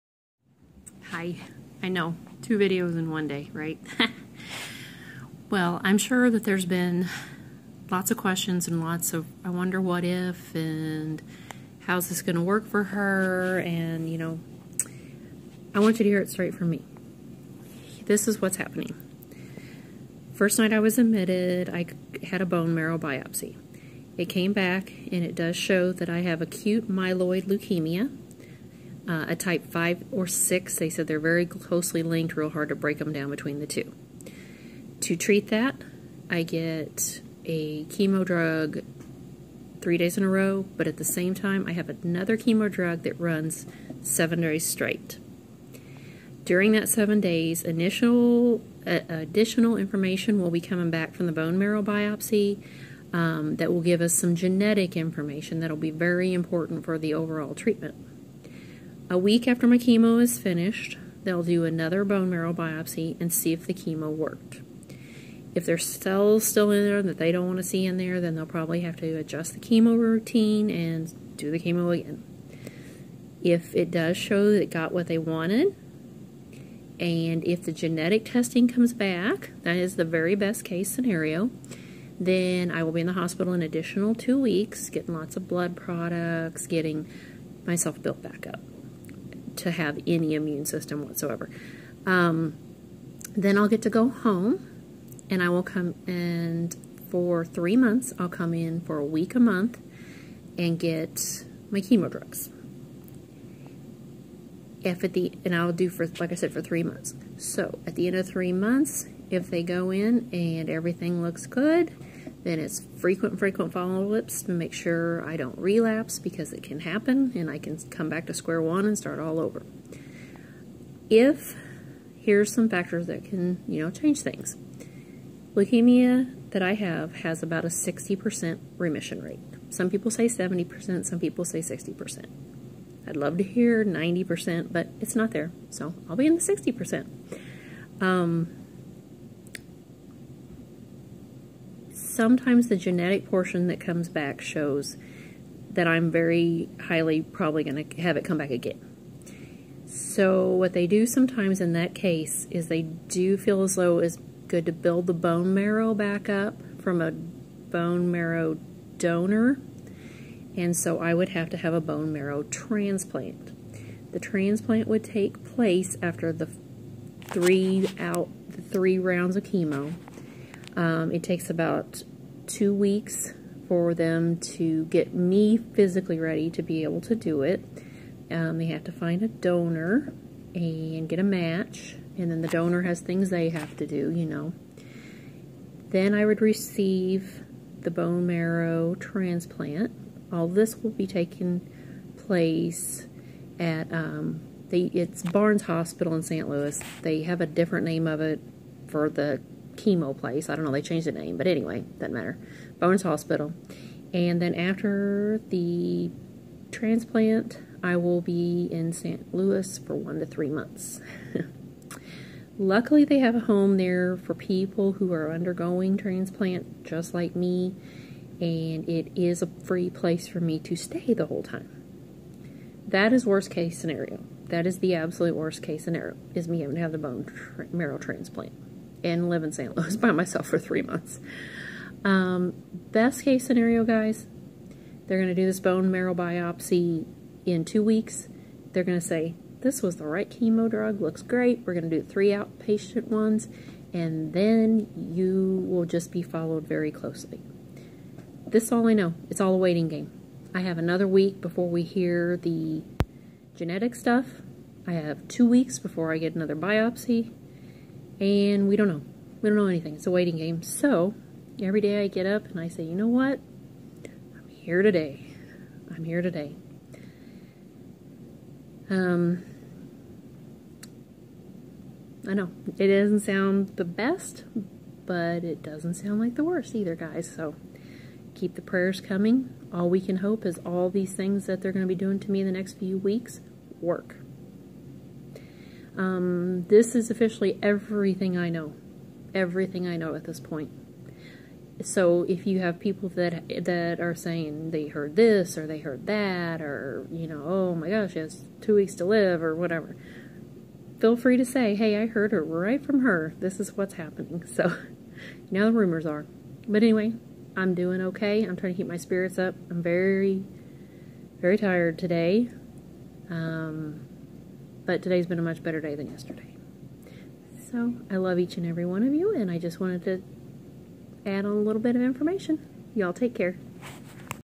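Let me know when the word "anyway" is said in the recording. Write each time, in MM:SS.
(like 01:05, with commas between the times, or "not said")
03:21, 05:06.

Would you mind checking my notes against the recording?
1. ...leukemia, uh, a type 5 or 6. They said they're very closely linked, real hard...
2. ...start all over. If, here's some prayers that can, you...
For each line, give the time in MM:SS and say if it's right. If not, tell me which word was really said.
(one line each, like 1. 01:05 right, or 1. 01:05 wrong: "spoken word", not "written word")
1. 00:27 right
2. 01:58 wrong: "factors", not "prayers".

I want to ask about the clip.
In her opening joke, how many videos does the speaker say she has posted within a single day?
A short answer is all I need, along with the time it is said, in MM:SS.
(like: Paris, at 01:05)
2, at 00:02.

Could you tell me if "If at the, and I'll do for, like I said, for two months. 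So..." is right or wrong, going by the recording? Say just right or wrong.
wrong.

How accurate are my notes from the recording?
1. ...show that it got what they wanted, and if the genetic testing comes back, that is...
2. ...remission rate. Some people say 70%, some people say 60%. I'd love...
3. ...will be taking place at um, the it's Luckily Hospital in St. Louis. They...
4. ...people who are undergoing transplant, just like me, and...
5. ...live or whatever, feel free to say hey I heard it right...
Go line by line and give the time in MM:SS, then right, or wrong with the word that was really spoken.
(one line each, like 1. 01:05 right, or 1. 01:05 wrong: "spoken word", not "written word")
1. 01:14 right
2. 02:08 right
3. 03:10 wrong: "Barnes", not "Luckily"
4. 03:34 right
5. 04:59 right.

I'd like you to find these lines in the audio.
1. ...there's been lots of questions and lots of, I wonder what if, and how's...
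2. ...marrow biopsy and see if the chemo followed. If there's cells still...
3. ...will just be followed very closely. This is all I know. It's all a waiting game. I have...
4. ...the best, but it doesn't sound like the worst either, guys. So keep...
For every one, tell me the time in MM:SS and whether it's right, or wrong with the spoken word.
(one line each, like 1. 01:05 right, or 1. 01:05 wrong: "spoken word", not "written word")
1. 00:06 right
2. 01:02 wrong: "worked", not "followed"
3. 04:05 right
4. 04:33 right.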